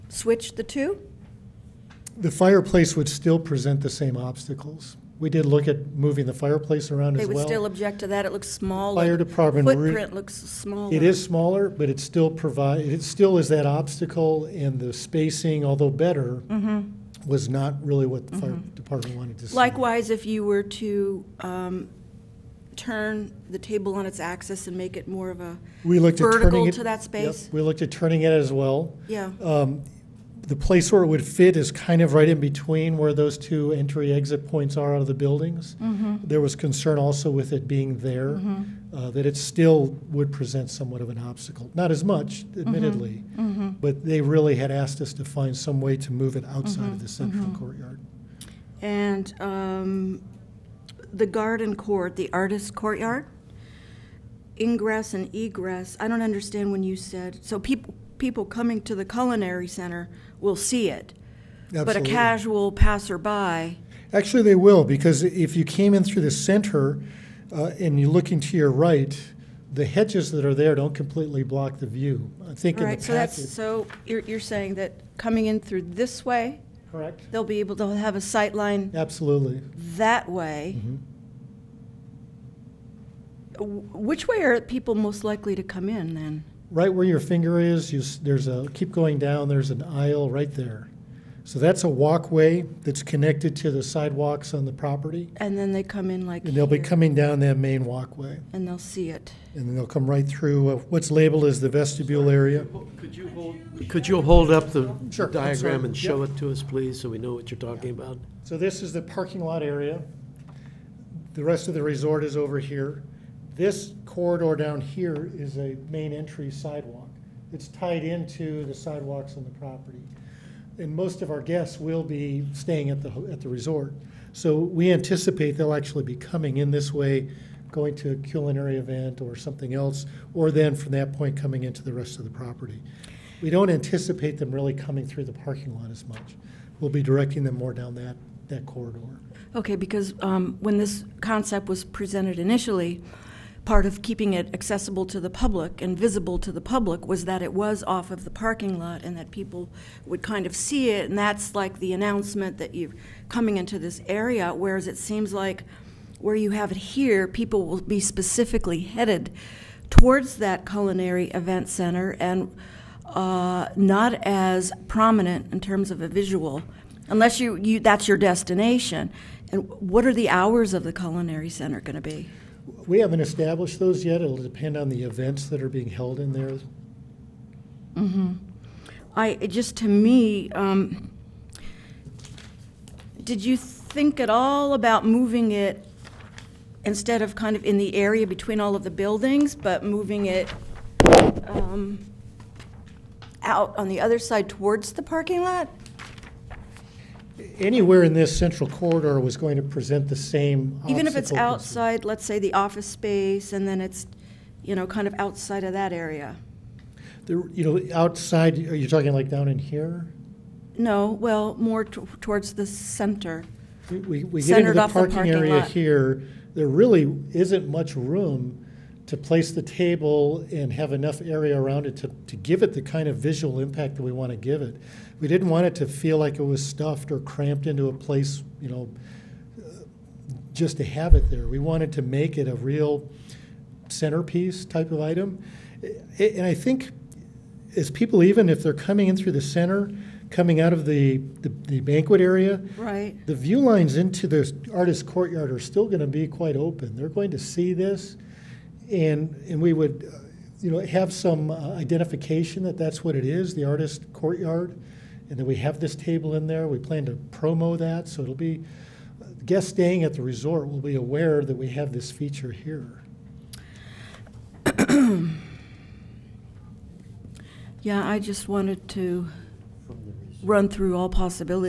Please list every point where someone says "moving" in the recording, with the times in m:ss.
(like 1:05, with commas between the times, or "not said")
0:05, 3:05, 3:09.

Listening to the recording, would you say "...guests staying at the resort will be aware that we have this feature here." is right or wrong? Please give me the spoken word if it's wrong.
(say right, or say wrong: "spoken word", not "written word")
right.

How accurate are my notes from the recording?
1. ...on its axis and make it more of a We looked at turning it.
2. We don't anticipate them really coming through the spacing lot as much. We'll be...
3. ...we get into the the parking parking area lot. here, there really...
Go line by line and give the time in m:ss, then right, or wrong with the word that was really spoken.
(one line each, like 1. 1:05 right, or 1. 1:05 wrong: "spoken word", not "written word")
1. 0:23 right
2. 2:13 wrong: "parking", not "spacing"
3. 3:34 right.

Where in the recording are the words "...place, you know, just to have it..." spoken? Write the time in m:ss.
3:47.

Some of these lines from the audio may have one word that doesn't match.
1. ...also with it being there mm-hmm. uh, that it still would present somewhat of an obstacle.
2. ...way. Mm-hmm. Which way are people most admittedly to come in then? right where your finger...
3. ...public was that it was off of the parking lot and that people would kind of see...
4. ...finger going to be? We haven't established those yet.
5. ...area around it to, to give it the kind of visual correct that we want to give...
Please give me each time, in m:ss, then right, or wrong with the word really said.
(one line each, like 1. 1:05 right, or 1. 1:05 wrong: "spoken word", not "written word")
1. 0:36 right
2. 1:20 wrong: "likely", not "admittedly"
3. 2:26 right
4. 2:51 wrong: "center", not "finger"
5. 3:41 wrong: "impact", not "correct".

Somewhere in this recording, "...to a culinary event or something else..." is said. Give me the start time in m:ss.
2:07.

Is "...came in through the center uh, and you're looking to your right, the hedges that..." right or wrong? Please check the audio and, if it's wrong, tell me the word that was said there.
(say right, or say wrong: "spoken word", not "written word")
right.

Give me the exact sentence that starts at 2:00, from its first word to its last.
And most of our guests will be staying at the, at the resort.